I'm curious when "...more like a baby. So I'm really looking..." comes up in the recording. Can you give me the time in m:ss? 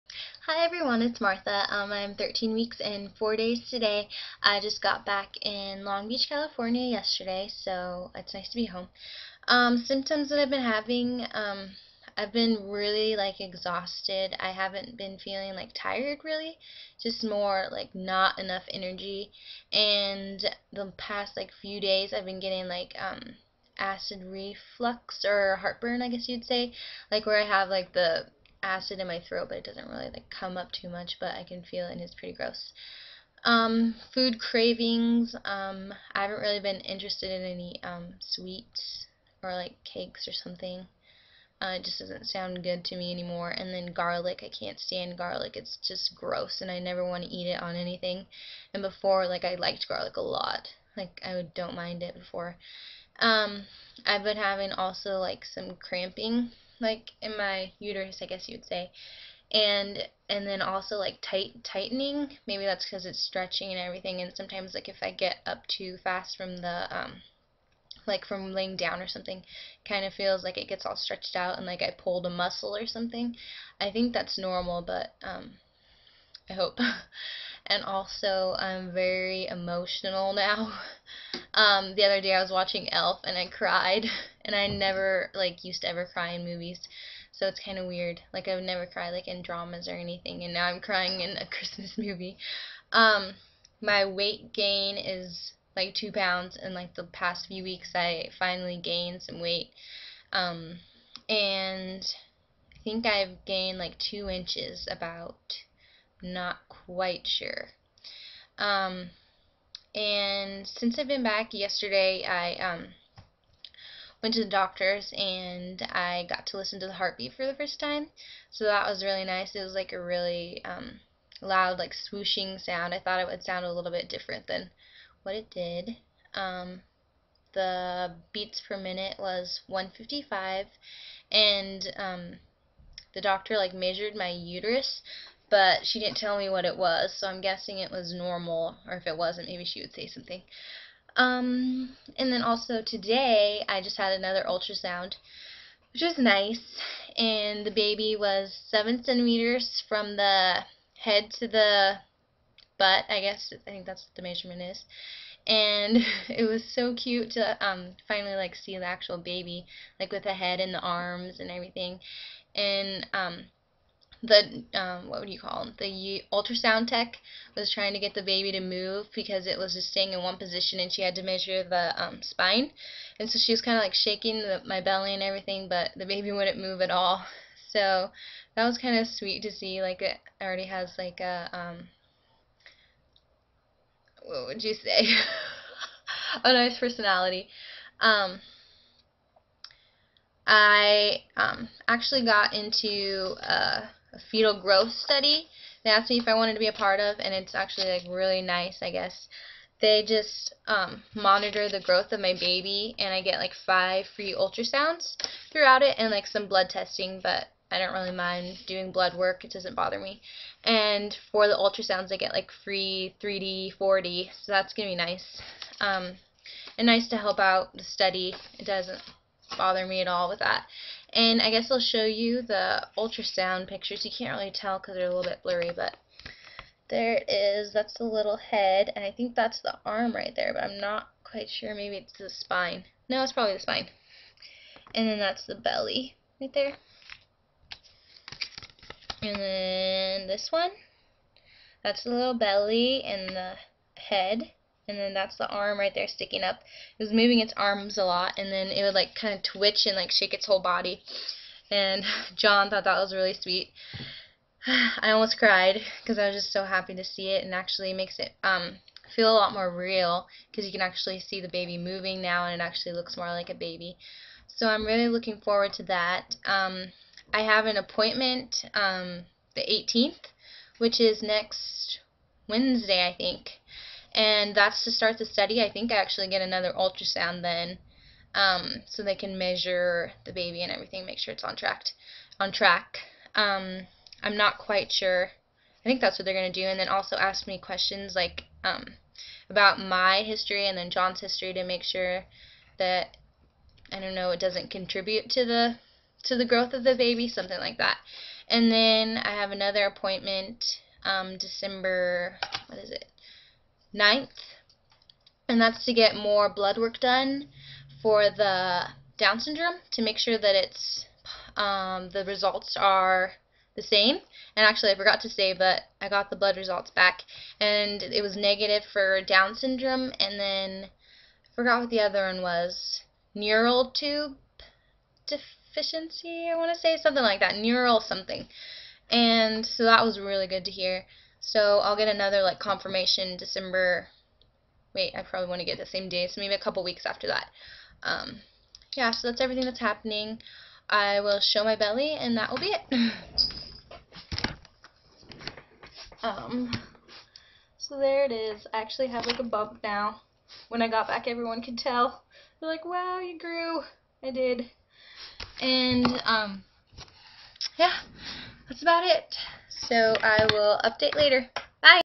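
4:23.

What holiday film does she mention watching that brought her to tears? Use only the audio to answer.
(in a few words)
Elf.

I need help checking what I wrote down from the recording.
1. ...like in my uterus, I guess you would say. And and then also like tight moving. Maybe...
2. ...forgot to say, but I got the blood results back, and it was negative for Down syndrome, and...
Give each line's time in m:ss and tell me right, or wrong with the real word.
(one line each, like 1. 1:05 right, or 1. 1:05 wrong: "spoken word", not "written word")
1. 0:56 wrong: "tightening", not "moving"
2. 5:14 right.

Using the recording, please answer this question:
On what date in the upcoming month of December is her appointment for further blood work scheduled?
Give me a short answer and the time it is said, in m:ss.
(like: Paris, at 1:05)
December 9th, at 5:03.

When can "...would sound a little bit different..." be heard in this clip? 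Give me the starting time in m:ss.
2:03.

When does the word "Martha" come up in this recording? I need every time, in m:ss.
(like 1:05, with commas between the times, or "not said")
0:01.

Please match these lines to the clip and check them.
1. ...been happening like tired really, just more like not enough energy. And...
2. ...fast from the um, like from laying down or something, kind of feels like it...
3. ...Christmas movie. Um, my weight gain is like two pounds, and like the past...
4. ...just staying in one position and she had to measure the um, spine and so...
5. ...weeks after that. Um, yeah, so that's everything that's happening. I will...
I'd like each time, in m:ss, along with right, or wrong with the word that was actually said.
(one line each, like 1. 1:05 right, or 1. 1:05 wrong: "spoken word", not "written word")
1. 0:14 wrong: "feeling", not "happening"
2. 1:06 right
3. 1:31 right
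4. 2:49 right
5. 5:36 right.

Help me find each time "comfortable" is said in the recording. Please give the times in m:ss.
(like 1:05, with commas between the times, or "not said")
not said.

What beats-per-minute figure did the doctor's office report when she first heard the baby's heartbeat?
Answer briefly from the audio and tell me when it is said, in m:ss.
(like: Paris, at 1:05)
155, at 2:09.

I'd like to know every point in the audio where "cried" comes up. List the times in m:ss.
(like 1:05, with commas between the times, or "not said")
1:23, 4:15.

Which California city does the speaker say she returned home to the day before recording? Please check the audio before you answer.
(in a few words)
Long Beach.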